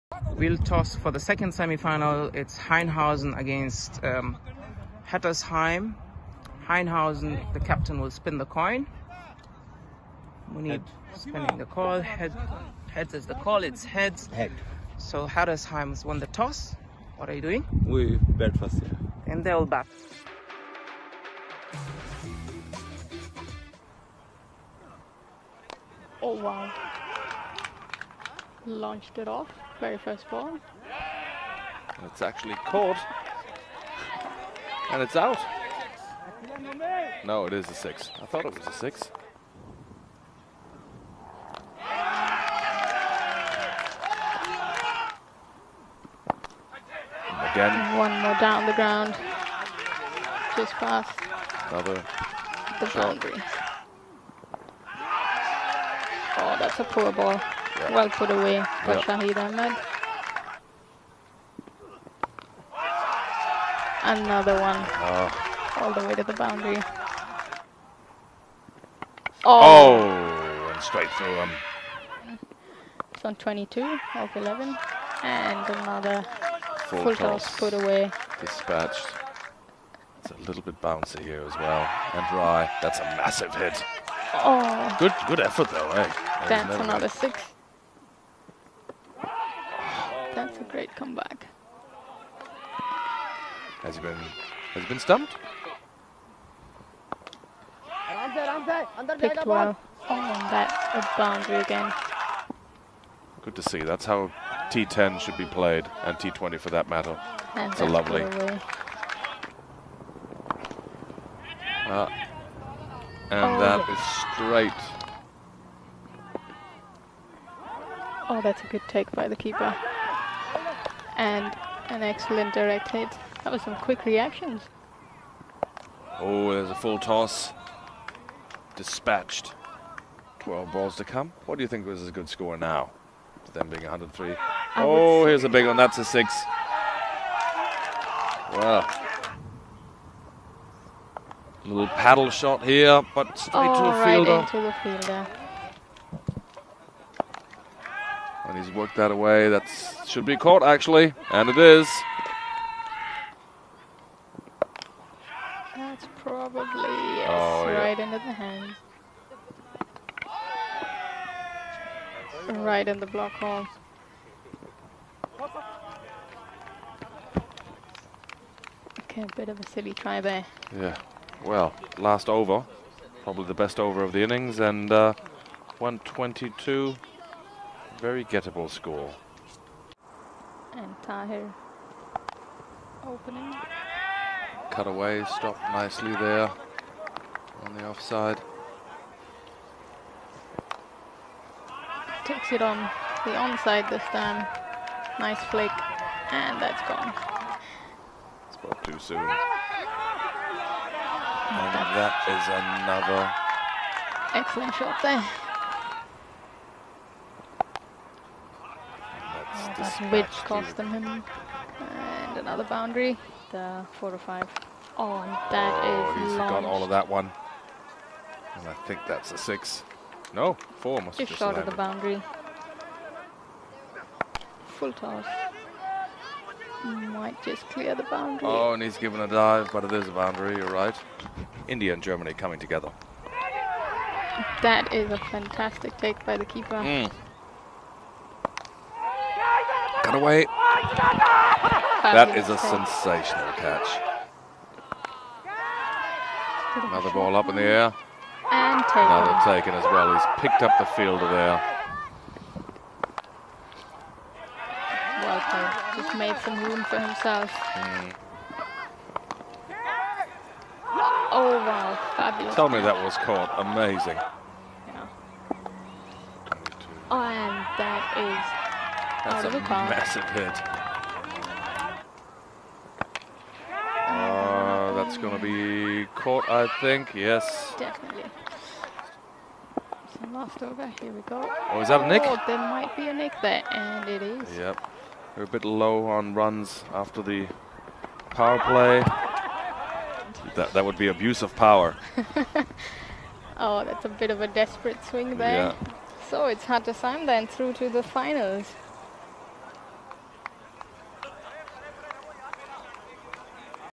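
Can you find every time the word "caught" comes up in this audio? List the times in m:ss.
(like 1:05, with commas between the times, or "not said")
0:32, 2:30, 4:23, 4:36.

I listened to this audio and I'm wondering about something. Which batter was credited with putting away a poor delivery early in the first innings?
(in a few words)
Shahid Ahmed.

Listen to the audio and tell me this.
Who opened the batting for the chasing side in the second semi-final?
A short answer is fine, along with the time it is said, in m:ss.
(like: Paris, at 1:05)
Tahir, at 3:00.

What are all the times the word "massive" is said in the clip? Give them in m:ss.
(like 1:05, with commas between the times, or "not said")
1:23, 4:29.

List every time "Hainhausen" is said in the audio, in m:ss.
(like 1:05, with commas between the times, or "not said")
0:02, 0:06.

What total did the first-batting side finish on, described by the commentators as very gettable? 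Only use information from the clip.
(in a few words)
122.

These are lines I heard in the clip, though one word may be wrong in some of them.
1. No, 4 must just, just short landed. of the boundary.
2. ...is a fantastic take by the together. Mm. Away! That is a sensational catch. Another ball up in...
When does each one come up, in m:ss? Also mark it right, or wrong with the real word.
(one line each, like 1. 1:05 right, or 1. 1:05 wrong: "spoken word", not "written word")
1. 3:40 right
2. 3:54 wrong: "keeper", not "together".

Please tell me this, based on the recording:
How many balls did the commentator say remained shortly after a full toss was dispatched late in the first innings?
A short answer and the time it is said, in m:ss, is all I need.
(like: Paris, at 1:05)
12, at 2:10.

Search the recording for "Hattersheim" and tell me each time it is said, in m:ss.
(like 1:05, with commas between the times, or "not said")
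0:05, 0:15.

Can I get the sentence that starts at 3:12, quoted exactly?
Takes it on the onside this time.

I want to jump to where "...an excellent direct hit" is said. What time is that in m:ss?
2:01.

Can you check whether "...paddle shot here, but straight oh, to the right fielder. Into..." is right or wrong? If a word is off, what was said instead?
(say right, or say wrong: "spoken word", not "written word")
right.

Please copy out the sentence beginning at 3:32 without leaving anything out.
And another boundary, the 4 to 5.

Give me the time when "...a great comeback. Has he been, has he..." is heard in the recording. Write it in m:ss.
1:30.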